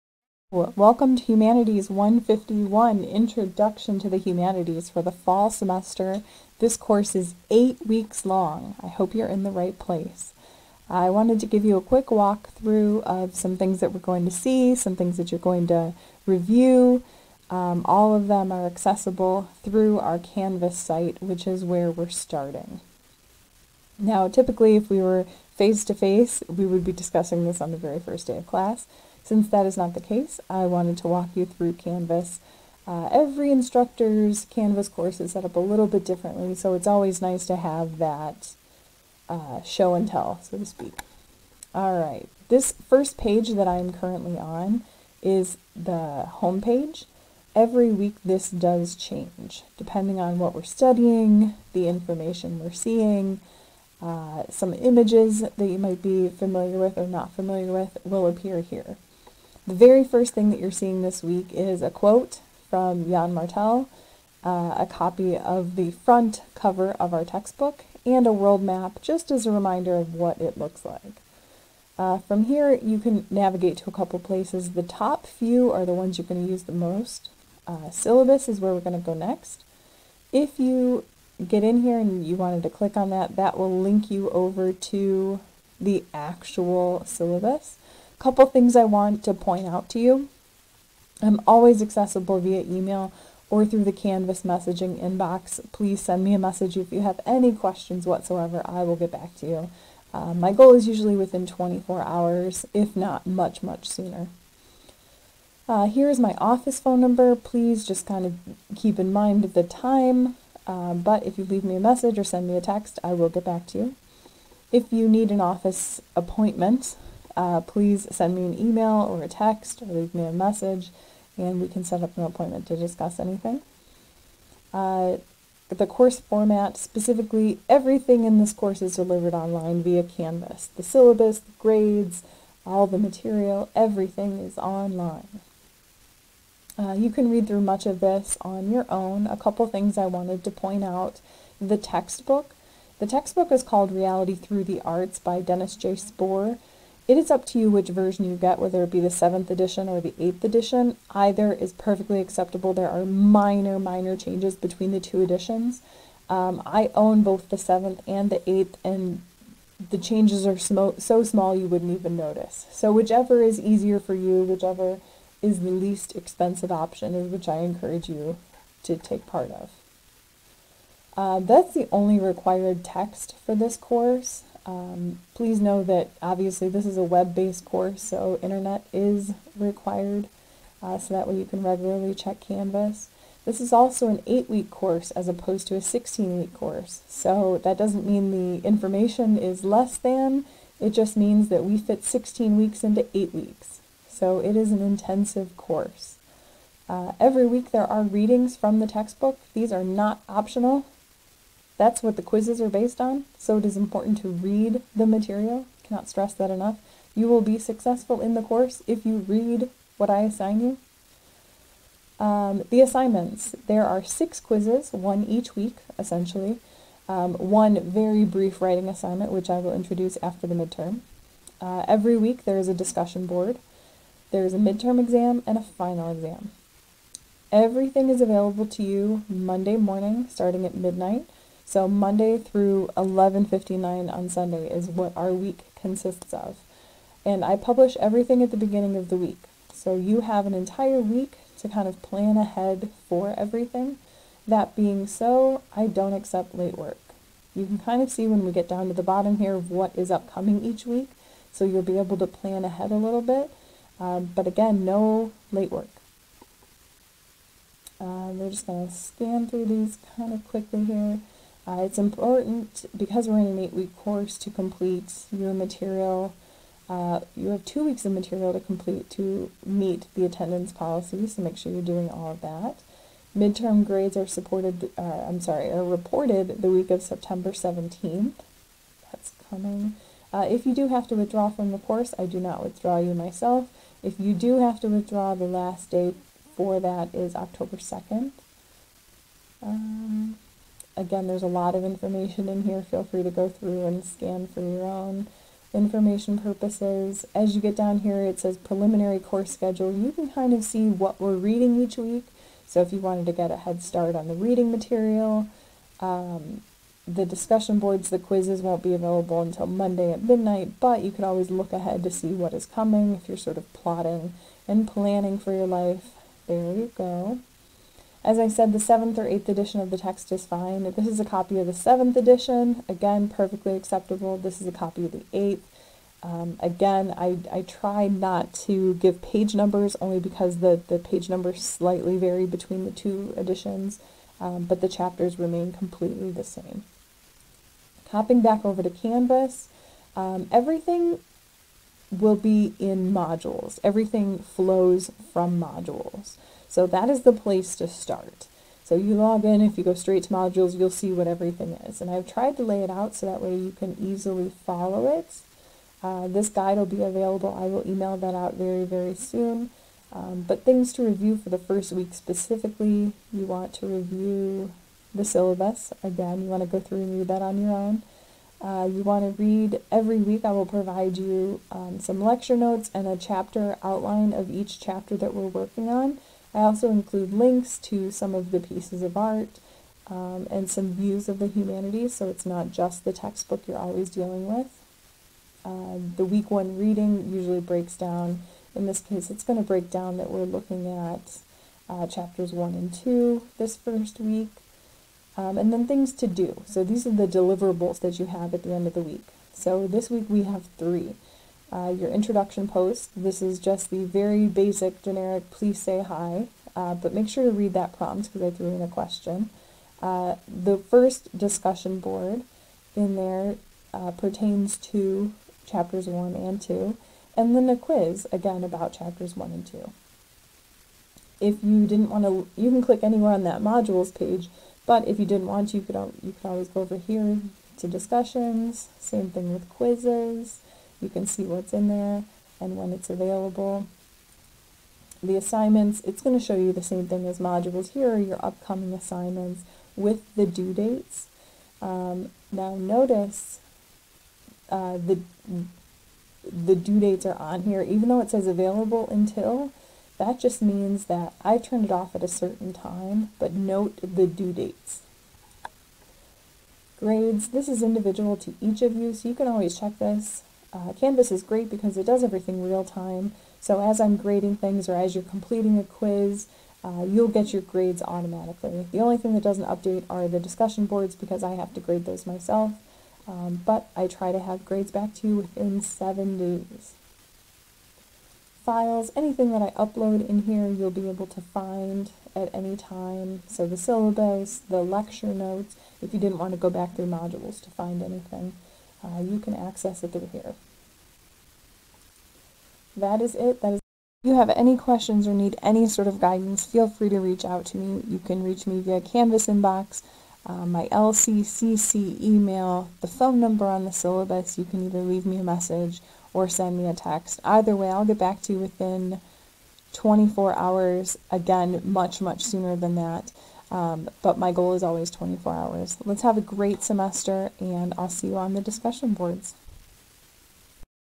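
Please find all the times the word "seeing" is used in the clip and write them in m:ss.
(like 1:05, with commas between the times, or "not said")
0:52, 1:00.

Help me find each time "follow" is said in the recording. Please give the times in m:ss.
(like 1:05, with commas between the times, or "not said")
5:54.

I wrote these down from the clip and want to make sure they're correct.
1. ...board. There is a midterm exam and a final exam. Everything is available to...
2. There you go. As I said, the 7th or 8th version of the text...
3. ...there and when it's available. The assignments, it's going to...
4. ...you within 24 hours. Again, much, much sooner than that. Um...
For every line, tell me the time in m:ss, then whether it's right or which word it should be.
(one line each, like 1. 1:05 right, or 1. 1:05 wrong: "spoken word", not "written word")
1. 3:43 right
2. 5:16 wrong: "edition", not "version"
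3. 7:11 right
4. 8:28 right.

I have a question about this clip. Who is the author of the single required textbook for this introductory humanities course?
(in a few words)
Dennis J. Sporre.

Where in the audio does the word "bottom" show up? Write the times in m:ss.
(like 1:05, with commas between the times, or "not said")
4:09.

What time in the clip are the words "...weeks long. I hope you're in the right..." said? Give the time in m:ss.
0:07.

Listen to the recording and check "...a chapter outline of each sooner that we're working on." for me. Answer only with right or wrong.
wrong.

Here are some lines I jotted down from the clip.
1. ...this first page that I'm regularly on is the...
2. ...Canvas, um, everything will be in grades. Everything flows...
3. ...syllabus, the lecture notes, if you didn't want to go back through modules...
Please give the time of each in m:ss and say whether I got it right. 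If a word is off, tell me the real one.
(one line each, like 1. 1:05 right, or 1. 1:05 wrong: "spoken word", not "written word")
1. 0:42 wrong: "currently", not "regularly"
2. 5:38 wrong: "modules", not "grades"
3. 8:03 right.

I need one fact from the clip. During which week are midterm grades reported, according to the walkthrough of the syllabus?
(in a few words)
September 17th.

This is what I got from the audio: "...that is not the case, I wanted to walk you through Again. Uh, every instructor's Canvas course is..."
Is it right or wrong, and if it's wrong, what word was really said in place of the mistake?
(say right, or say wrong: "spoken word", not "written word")
wrong: "Canvas", not "Again".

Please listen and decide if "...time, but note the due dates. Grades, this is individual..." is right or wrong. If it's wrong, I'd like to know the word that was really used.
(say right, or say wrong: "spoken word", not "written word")
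right.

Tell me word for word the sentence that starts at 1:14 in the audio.
The top few are the ones you're going to use the most.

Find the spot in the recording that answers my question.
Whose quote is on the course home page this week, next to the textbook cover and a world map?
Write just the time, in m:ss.
1:03.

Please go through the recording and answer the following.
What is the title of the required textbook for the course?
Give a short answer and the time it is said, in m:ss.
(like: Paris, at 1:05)
Reality Through the Arts, at 2:23.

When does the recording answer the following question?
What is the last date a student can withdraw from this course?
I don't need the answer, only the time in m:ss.
4:47.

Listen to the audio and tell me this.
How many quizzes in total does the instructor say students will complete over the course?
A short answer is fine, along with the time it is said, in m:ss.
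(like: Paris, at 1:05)
6, at 3:34.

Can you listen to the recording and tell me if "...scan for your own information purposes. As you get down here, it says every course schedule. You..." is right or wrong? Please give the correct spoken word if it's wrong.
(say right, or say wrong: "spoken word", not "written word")
wrong: "preliminary", not "every".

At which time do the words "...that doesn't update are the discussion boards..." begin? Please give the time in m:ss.
7:49.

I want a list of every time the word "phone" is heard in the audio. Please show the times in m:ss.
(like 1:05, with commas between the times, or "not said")
1:46, 8:23.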